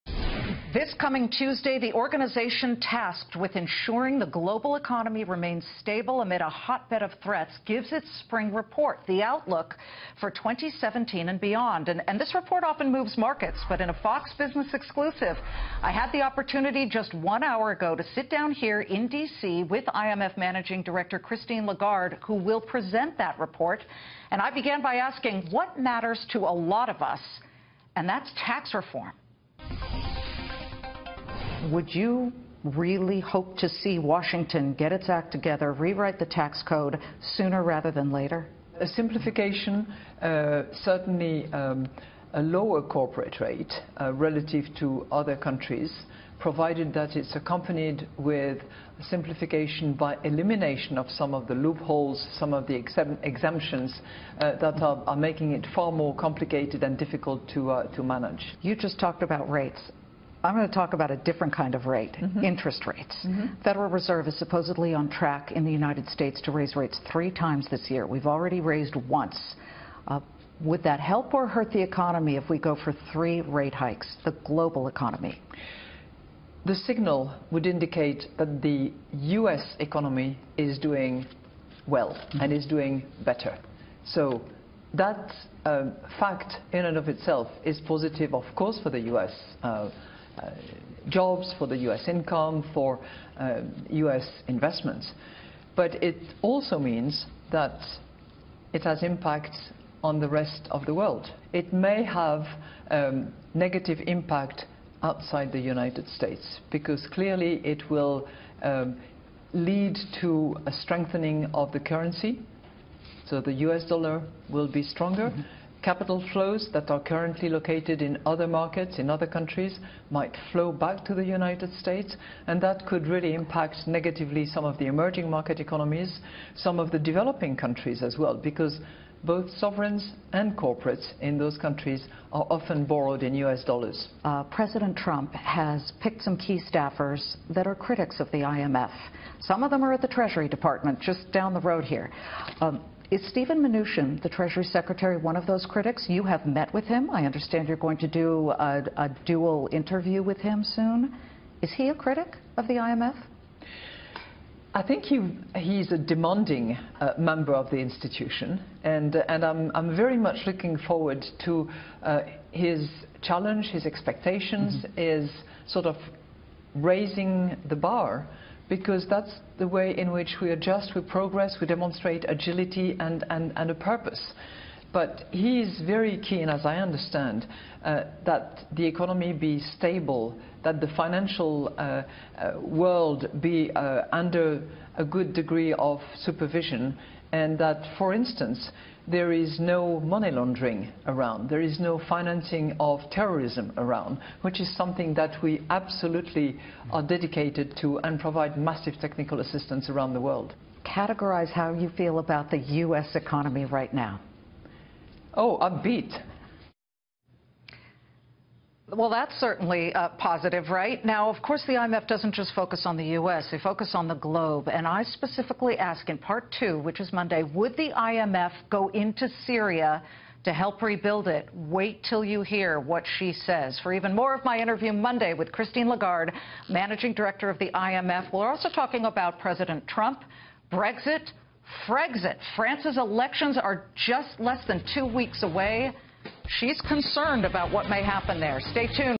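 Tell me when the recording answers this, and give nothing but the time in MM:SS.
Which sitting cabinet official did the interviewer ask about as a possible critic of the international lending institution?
02:23.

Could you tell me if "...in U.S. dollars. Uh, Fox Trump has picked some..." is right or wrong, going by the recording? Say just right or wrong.
wrong.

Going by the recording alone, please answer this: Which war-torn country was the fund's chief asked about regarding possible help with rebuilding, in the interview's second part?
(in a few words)
Syria.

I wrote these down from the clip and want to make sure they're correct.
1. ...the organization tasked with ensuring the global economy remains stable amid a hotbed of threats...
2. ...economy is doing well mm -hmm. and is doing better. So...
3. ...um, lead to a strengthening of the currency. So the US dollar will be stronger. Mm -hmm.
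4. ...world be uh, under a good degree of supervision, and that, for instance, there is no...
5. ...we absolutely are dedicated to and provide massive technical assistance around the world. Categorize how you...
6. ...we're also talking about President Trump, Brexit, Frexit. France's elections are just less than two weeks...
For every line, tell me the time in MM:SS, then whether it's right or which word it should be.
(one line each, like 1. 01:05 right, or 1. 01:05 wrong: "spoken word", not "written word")
1. 00:01 right
2. 01:19 right
3. 01:48 right
4. 03:02 right
5. 03:15 right
6. 03:48 right.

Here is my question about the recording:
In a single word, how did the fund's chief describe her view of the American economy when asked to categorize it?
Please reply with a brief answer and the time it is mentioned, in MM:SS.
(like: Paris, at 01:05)
Upbeat, at 03:25.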